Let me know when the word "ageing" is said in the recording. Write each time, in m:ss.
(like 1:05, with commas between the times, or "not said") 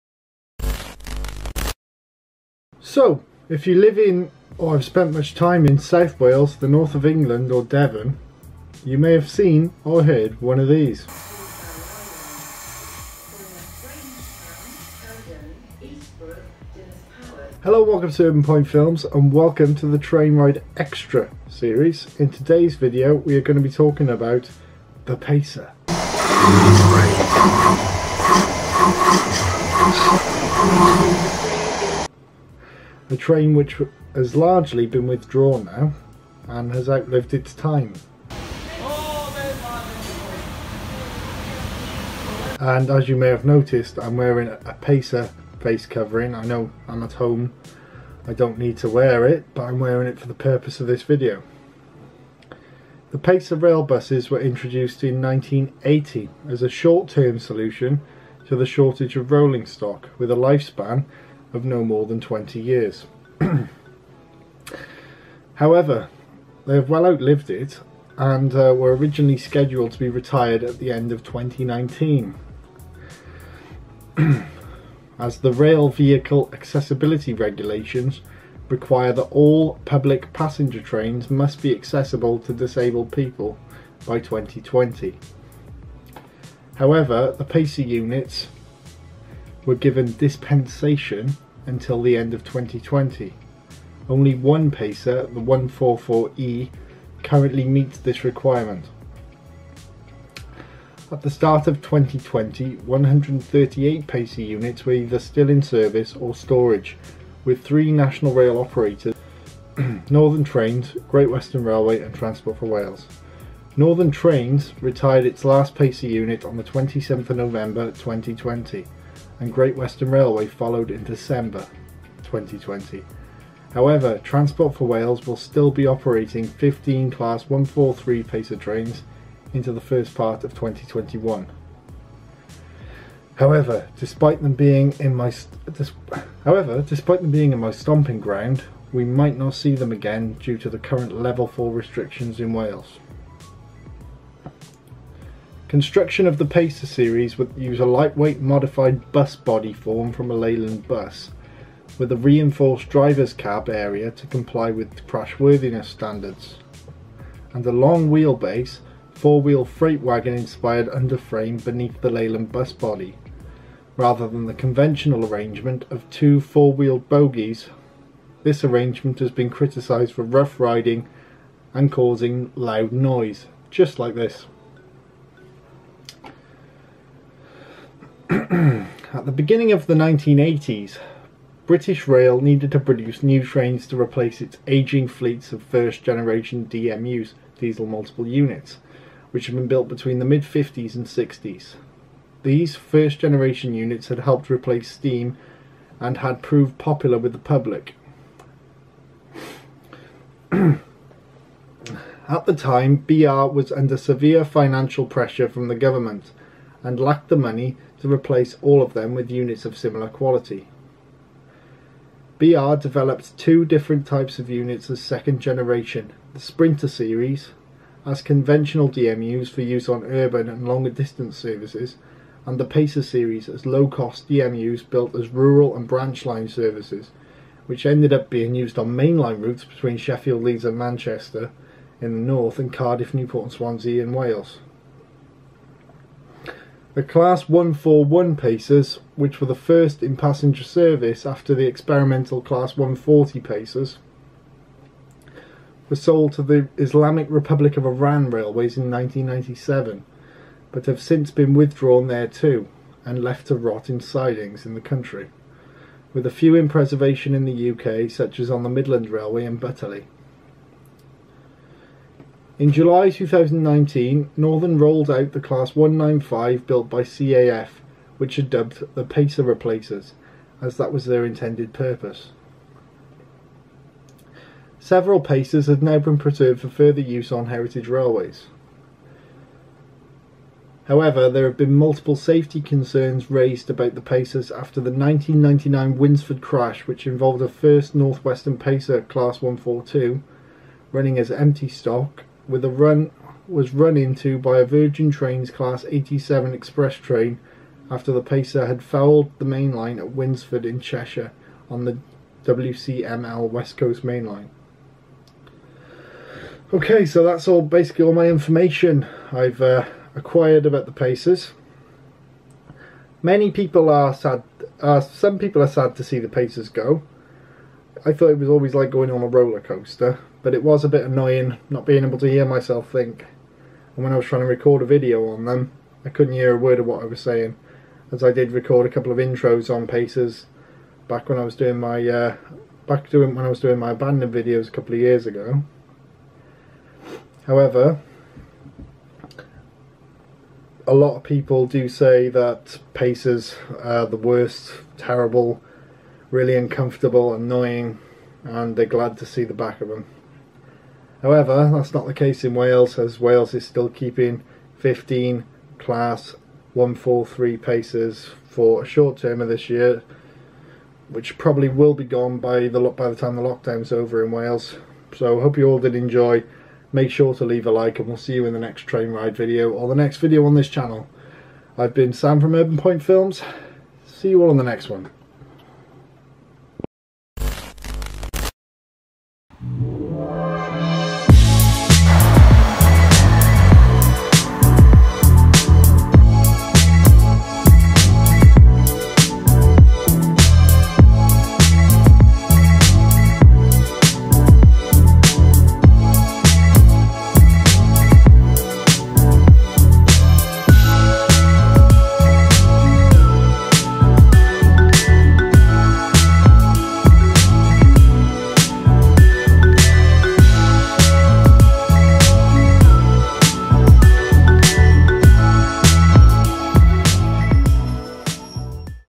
3:04.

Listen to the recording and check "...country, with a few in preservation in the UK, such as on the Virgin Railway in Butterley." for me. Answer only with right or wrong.
wrong.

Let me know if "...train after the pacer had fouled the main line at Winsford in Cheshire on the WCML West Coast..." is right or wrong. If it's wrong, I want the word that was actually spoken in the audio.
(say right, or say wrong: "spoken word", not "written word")
right.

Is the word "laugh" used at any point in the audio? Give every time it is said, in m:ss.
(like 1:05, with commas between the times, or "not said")
not said.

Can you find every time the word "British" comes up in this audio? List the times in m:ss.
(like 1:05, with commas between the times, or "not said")
3:01.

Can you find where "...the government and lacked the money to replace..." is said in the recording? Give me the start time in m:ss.
3:25.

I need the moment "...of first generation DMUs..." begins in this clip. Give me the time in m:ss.
3:05.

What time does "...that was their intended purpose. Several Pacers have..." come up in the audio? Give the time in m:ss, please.
4:30.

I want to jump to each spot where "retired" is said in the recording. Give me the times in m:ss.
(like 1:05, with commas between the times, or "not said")
1:10, 1:54.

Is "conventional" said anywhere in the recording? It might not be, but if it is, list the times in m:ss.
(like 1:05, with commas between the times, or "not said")
2:44, 3:38.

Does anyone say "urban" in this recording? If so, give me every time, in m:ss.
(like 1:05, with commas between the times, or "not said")
0:18, 3:40, 6:12.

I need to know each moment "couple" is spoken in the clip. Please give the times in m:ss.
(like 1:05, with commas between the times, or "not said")
5:28, 5:34.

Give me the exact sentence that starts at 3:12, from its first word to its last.
These first generation units had helped replace steam and had proved popular with the public.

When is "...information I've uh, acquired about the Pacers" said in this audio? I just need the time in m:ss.
5:08.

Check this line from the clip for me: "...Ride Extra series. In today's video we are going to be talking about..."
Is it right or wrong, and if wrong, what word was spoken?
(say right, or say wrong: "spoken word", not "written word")
right.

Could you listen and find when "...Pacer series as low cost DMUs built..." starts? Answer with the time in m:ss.
3:42.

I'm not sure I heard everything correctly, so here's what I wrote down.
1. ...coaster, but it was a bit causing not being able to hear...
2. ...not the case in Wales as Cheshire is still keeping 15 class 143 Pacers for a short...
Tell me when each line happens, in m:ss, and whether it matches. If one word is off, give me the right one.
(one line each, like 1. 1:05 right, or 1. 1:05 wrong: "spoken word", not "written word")
1. 5:19 wrong: "annoying", not "causing"
2. 5:51 wrong: "Wales", not "Cheshire".